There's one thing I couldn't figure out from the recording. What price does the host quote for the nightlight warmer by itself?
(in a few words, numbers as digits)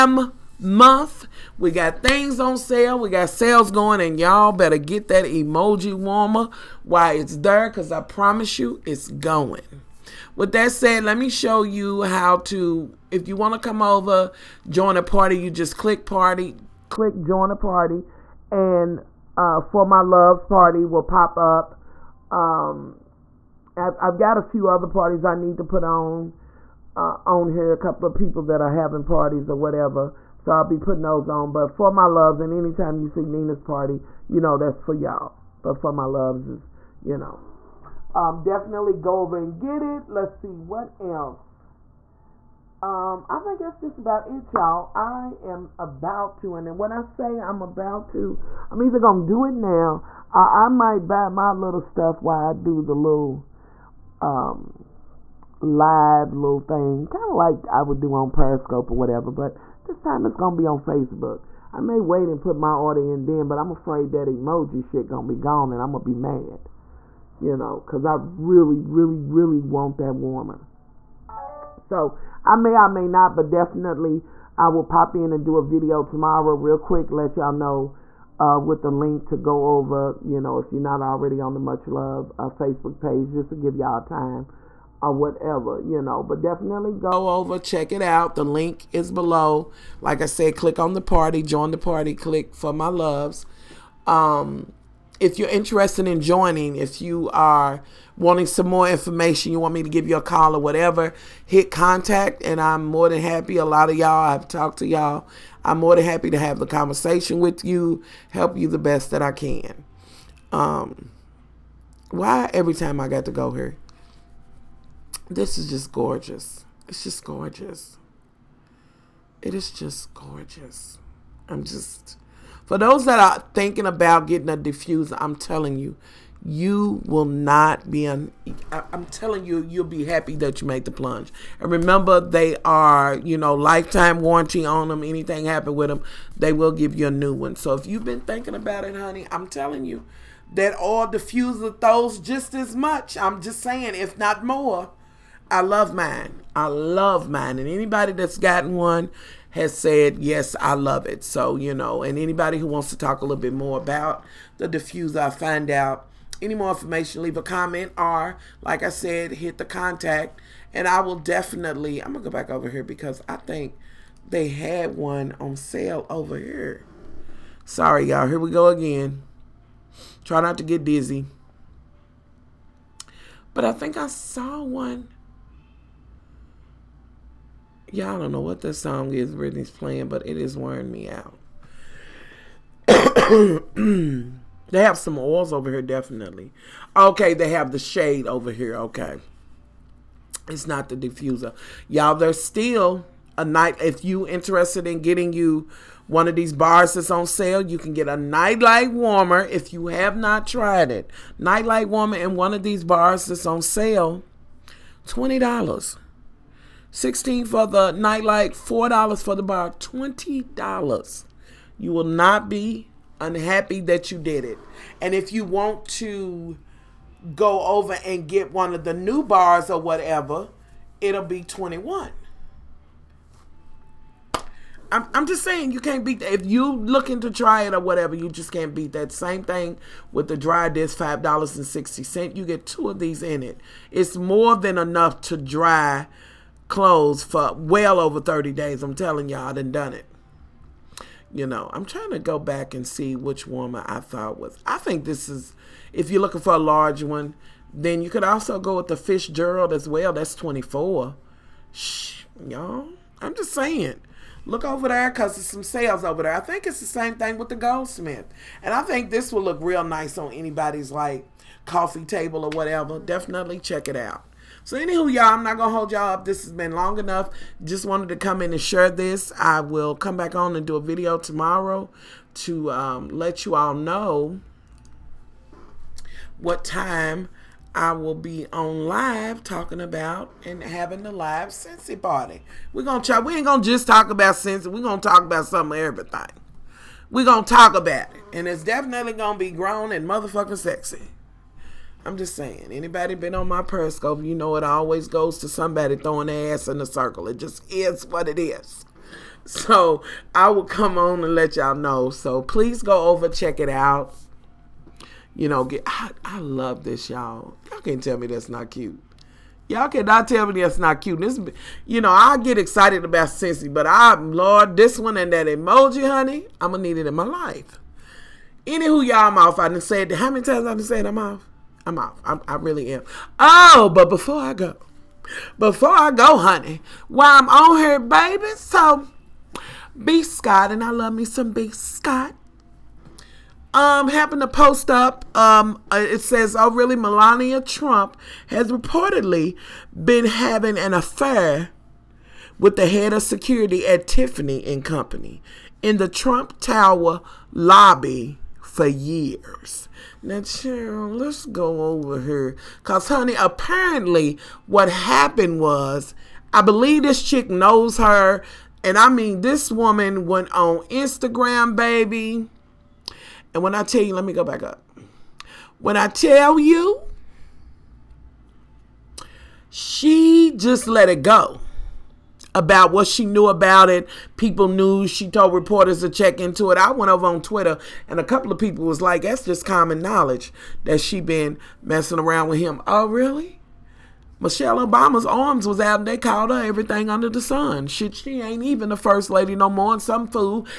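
$16.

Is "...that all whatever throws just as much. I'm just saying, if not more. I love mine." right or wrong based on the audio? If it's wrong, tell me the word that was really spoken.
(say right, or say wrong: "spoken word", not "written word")
wrong: "diffuser", not "whatever".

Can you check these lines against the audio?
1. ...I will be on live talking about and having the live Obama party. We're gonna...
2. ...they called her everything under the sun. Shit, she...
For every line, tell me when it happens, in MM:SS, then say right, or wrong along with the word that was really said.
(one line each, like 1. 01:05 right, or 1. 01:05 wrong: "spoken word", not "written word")
1. 04:37 wrong: "Scentsy", not "Obama"
2. 06:26 right.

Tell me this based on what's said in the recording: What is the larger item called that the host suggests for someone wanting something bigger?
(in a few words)
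Fitzgerald.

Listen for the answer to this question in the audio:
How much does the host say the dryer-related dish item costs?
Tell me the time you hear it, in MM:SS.
03:50.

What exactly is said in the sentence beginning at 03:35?
And if you want to go over and get one of the new bars or whatever, it'll be 21.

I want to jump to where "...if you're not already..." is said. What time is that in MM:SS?
01:20.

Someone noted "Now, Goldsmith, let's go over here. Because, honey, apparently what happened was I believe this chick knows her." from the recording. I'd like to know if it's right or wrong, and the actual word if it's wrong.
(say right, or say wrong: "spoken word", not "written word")
wrong: "Cheryl", not "Goldsmith".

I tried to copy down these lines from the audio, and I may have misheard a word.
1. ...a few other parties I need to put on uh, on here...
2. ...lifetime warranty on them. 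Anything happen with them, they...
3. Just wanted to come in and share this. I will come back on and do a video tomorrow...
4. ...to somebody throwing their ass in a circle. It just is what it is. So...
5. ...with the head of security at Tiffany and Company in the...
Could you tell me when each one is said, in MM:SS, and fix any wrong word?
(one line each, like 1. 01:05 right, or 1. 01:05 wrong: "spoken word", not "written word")
1. 00:24 right
2. 02:13 right
3. 04:27 right
4. 04:55 right
5. 05:42 right.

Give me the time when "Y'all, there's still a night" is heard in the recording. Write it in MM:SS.
03:11.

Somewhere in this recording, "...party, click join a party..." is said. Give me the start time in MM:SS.
00:16.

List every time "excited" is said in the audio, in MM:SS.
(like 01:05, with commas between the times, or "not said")
05:12.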